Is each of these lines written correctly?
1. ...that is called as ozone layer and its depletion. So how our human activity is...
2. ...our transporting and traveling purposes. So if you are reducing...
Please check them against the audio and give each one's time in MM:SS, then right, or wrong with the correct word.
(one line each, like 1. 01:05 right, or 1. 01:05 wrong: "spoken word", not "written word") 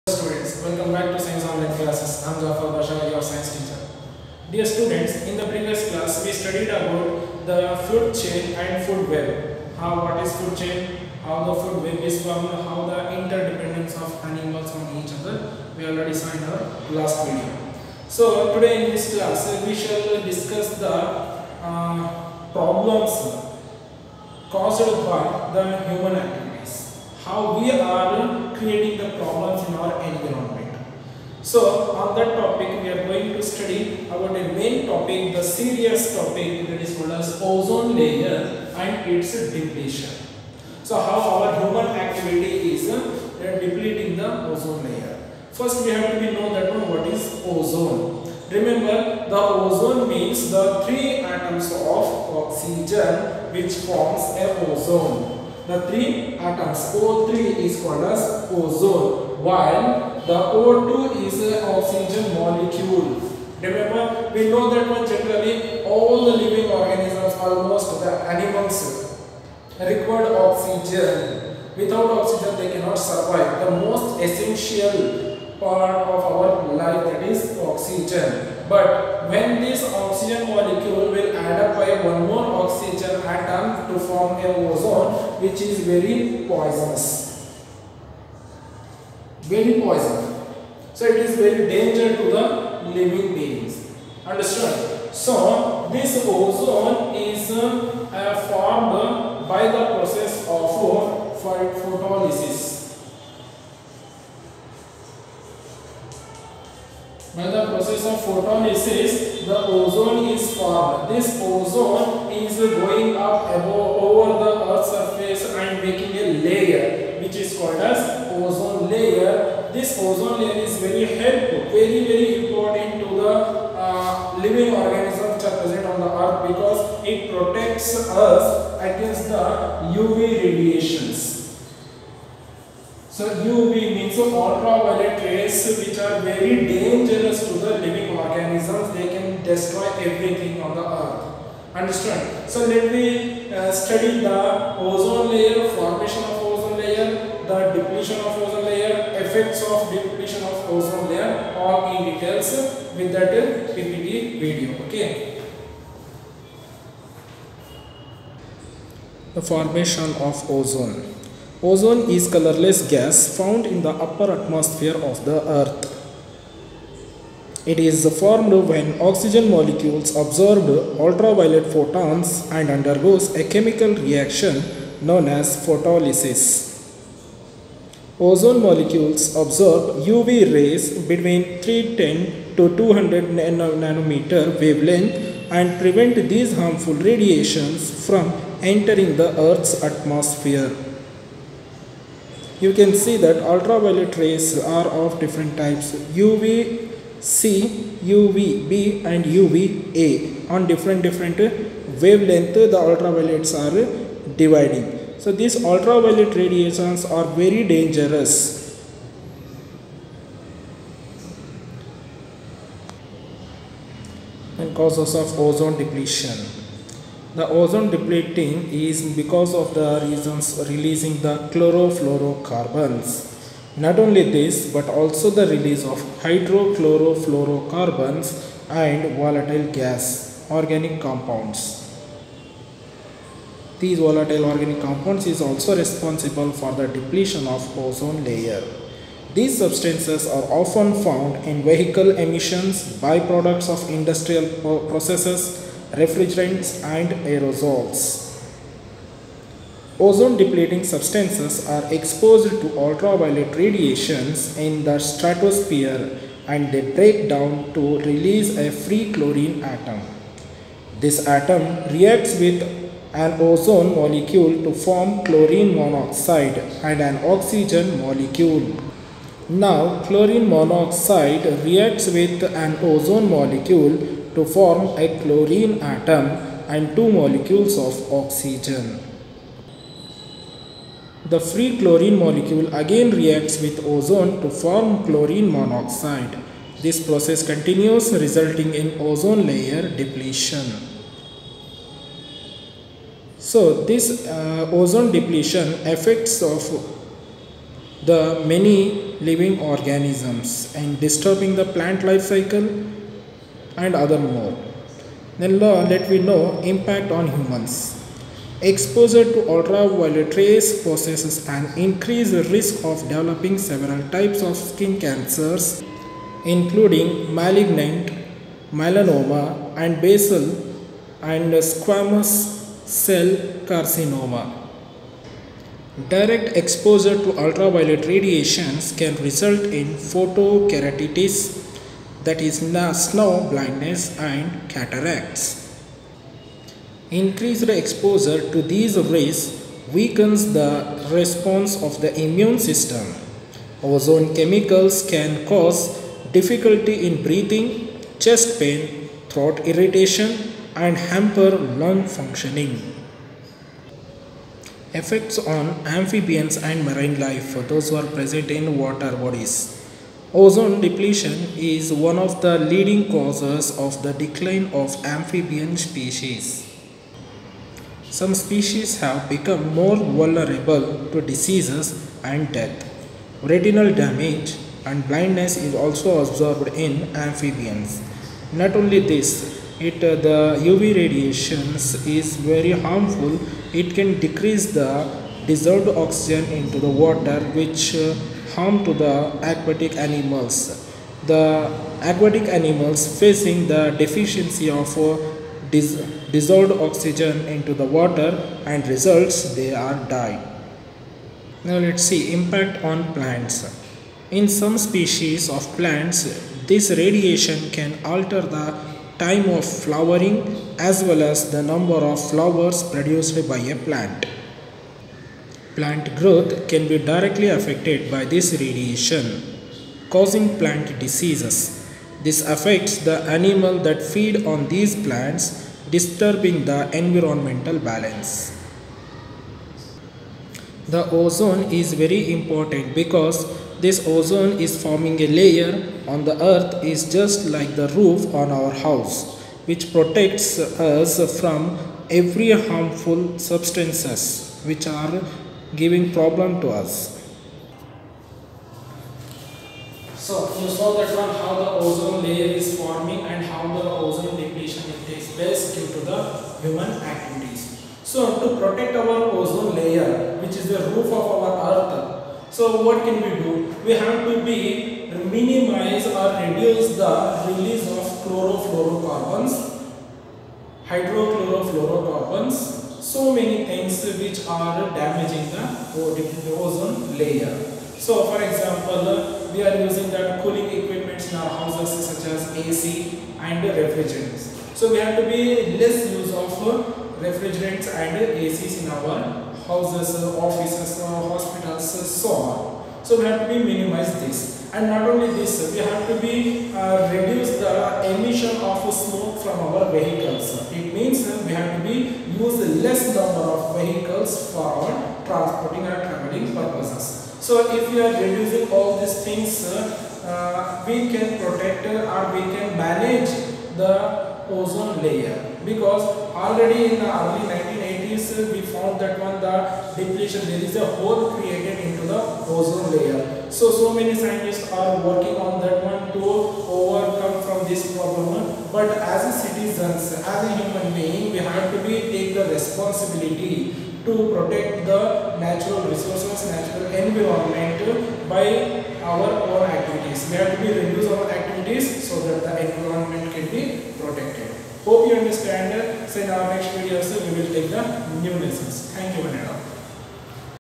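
1. 00:36 right
2. 08:24 right.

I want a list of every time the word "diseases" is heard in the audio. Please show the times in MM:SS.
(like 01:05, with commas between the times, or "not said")
06:11, 07:01.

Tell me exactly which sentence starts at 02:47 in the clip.
It is formed when oxygen molecules absorb ultraviolet photons and undergoes a chemical reaction known as photolysis.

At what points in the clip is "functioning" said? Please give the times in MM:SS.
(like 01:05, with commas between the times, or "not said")
05:52.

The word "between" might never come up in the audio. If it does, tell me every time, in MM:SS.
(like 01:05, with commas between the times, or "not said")
03:01.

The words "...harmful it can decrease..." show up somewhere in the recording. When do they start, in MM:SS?
06:22.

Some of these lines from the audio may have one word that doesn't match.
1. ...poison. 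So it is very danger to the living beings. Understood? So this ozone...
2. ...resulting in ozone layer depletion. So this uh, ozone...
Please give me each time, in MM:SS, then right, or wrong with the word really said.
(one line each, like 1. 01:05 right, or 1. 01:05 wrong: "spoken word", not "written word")
1. 01:29 right
2. 04:48 right.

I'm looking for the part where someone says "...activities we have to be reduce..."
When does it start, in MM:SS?
08:59.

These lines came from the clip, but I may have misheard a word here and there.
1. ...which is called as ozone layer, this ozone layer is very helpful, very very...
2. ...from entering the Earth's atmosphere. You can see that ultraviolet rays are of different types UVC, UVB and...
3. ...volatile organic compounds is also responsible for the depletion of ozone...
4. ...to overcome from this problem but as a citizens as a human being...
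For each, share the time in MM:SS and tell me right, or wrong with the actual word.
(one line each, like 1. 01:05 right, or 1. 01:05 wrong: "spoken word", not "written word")
1. 01:57 right
2. 03:08 right
3. 03:53 right
4. 08:46 right.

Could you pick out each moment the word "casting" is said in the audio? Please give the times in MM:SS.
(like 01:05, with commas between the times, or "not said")
not said.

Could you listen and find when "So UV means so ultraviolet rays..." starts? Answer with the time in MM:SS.
02:13.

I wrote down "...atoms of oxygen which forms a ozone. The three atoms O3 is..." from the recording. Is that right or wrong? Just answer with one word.
right.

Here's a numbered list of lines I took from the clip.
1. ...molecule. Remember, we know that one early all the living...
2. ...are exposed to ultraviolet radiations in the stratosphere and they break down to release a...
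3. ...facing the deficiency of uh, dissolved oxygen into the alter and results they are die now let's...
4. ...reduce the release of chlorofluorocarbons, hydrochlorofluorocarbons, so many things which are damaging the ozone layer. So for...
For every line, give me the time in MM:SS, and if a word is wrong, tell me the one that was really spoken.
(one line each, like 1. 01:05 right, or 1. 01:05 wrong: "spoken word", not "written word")
1. 01:02 wrong: "generally", not "early"
2. 04:11 right
3. 06:33 wrong: "water", not "alter"
4. 07:46 right.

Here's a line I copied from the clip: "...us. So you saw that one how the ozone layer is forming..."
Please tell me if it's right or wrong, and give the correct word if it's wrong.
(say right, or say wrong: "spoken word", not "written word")
right.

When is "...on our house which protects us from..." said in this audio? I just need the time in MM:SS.
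07:18.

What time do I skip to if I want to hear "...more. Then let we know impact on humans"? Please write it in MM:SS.
05:04.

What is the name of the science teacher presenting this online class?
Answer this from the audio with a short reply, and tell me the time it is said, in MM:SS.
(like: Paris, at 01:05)
Zafar Bashar, at 00:02.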